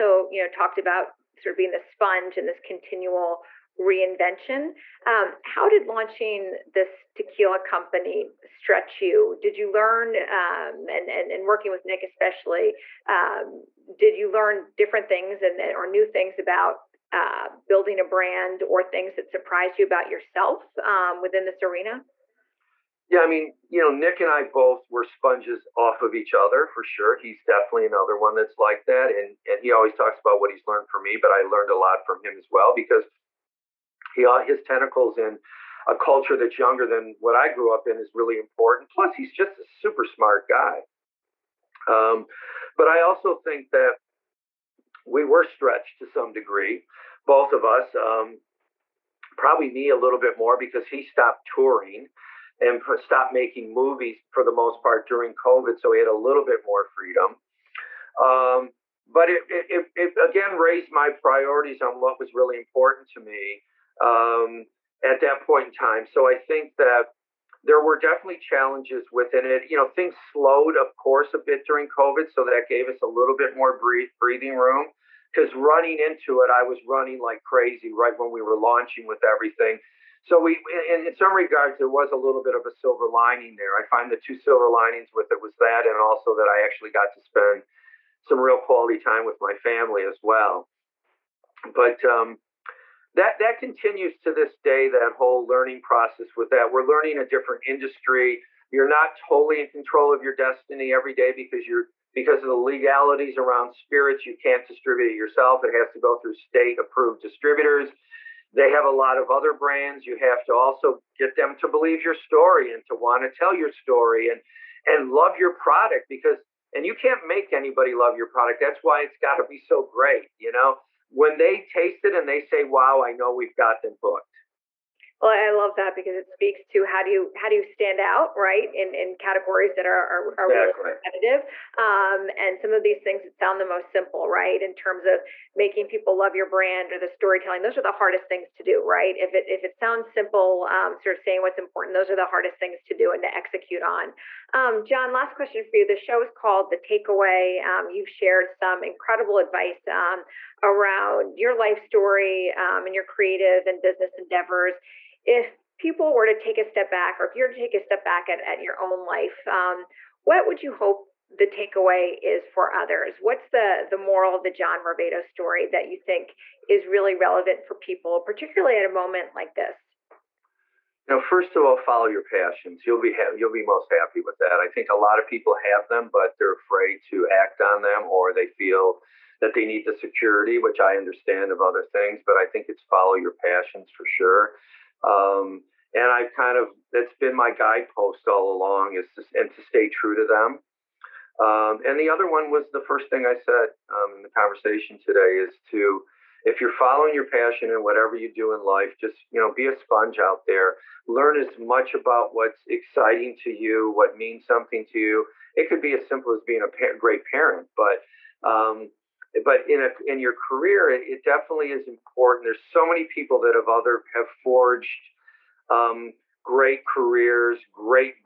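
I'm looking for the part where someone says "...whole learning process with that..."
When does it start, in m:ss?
1:35.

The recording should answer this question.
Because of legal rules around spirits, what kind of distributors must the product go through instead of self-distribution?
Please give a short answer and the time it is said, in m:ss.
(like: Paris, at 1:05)
State approved distributors, at 1:46.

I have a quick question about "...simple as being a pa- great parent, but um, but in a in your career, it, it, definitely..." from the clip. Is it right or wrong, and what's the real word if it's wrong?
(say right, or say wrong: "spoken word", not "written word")
right.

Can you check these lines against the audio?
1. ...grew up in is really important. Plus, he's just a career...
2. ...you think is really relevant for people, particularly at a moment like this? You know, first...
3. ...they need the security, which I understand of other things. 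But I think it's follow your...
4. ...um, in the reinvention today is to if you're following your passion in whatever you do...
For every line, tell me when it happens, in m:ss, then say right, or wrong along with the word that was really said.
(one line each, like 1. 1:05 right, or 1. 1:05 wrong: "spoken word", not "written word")
1. 0:37 wrong: "super", not "career"
2. 2:45 right
3. 2:59 right
4. 3:13 wrong: "conversation", not "reinvention".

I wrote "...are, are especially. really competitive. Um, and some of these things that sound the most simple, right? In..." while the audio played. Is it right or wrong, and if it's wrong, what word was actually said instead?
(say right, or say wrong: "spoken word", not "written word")
wrong: "exactly", not "especially".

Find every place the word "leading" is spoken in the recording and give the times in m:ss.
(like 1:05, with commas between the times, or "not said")
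not said.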